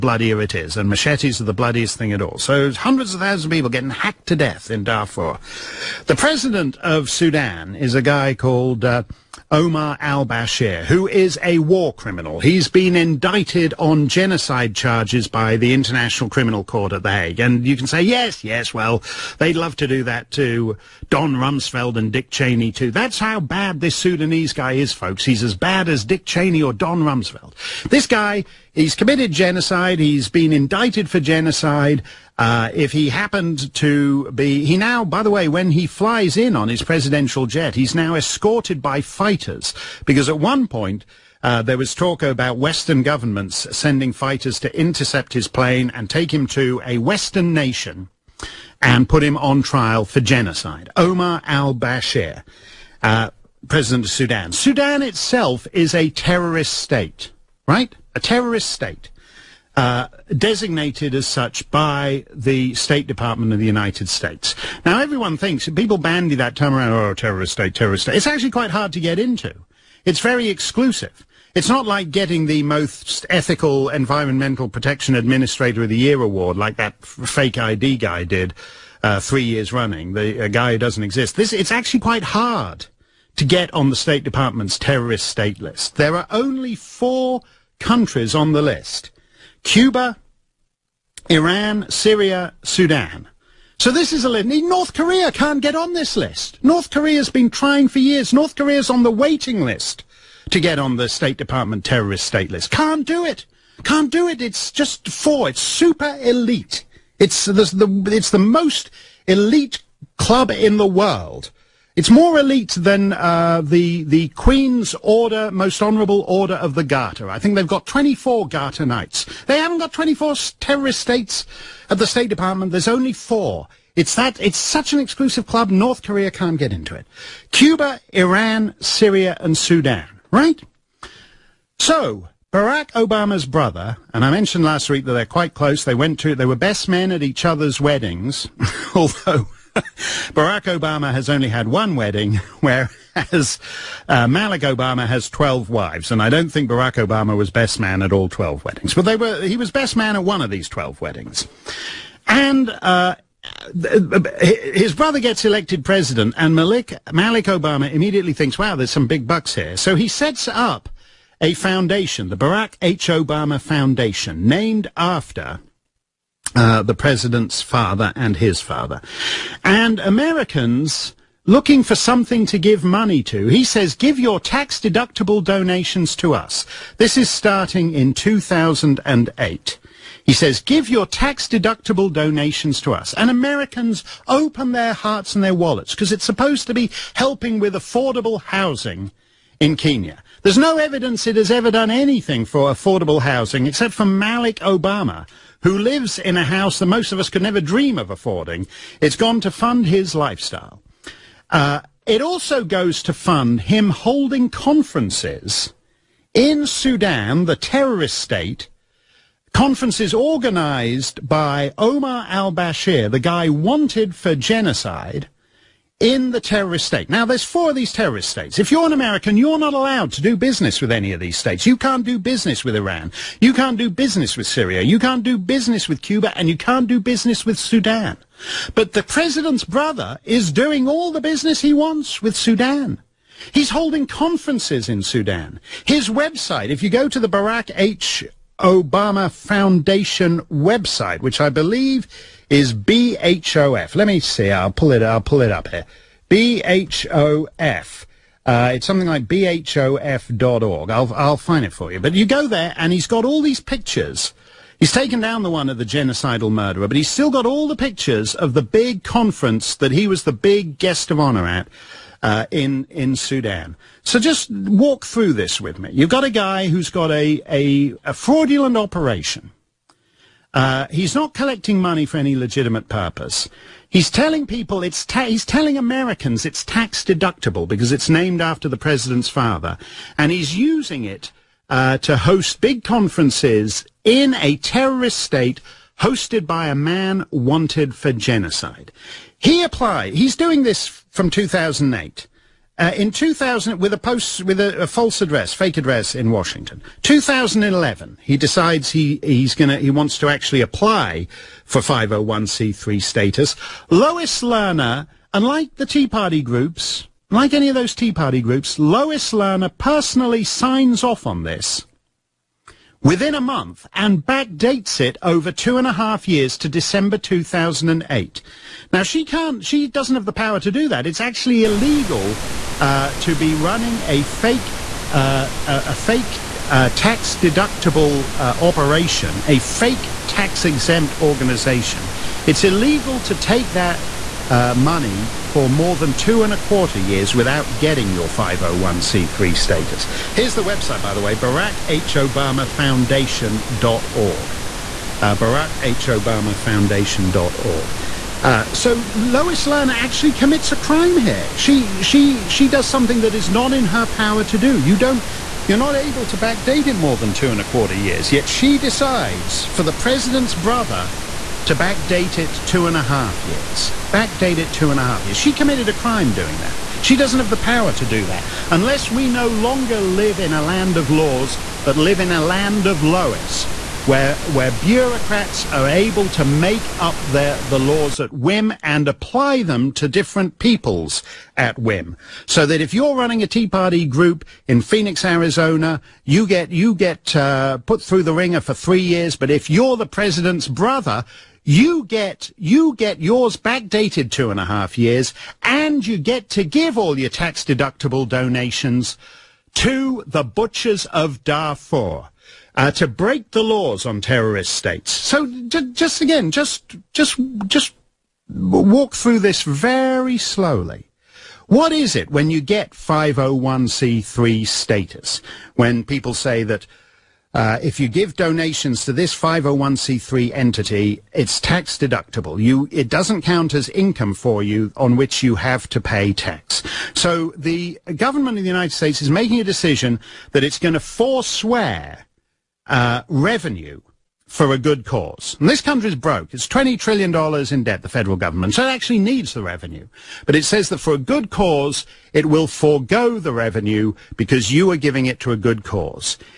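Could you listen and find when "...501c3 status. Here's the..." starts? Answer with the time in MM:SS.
05:38.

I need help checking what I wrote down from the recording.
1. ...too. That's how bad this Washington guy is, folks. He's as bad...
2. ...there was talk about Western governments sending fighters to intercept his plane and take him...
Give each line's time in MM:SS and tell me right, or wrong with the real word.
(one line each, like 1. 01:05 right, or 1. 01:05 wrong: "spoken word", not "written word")
1. 00:22 wrong: "Sudanese", not "Washington"
2. 00:41 right.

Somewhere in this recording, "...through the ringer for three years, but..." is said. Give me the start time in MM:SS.
06:28.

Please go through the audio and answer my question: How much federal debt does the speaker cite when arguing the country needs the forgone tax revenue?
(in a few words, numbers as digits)
$20 trillion.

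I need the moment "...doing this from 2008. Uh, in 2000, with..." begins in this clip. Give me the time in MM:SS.
04:50.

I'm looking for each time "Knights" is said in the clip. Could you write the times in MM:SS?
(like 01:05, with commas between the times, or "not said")
01:58.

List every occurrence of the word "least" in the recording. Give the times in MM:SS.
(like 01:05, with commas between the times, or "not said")
not said.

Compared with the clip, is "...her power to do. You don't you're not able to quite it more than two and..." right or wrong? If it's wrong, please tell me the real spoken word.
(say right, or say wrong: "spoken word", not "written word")
wrong: "backdate", not "quite".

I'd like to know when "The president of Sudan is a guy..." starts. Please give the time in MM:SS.
00:06.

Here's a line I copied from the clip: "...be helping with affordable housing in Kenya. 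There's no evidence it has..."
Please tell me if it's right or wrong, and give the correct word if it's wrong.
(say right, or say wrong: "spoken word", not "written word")
right.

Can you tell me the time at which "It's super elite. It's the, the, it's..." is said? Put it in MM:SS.
01:45.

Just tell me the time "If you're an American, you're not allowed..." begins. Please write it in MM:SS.
03:38.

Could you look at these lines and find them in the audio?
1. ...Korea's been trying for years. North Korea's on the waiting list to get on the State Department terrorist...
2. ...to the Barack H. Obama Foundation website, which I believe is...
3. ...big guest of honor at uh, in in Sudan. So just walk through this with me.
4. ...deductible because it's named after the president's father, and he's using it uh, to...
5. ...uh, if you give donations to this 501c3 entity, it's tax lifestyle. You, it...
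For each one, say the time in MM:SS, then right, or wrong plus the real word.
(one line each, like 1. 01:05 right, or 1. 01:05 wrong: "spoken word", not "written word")
1. 01:36 right
2. 03:57 right
3. 04:20 right
4. 04:37 right
5. 06:57 wrong: "deductible", not "lifestyle".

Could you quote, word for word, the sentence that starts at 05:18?
Now she can't, she doesn't have the power to do that.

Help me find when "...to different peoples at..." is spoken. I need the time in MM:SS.
06:19.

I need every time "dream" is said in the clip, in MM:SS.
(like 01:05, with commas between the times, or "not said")
03:17.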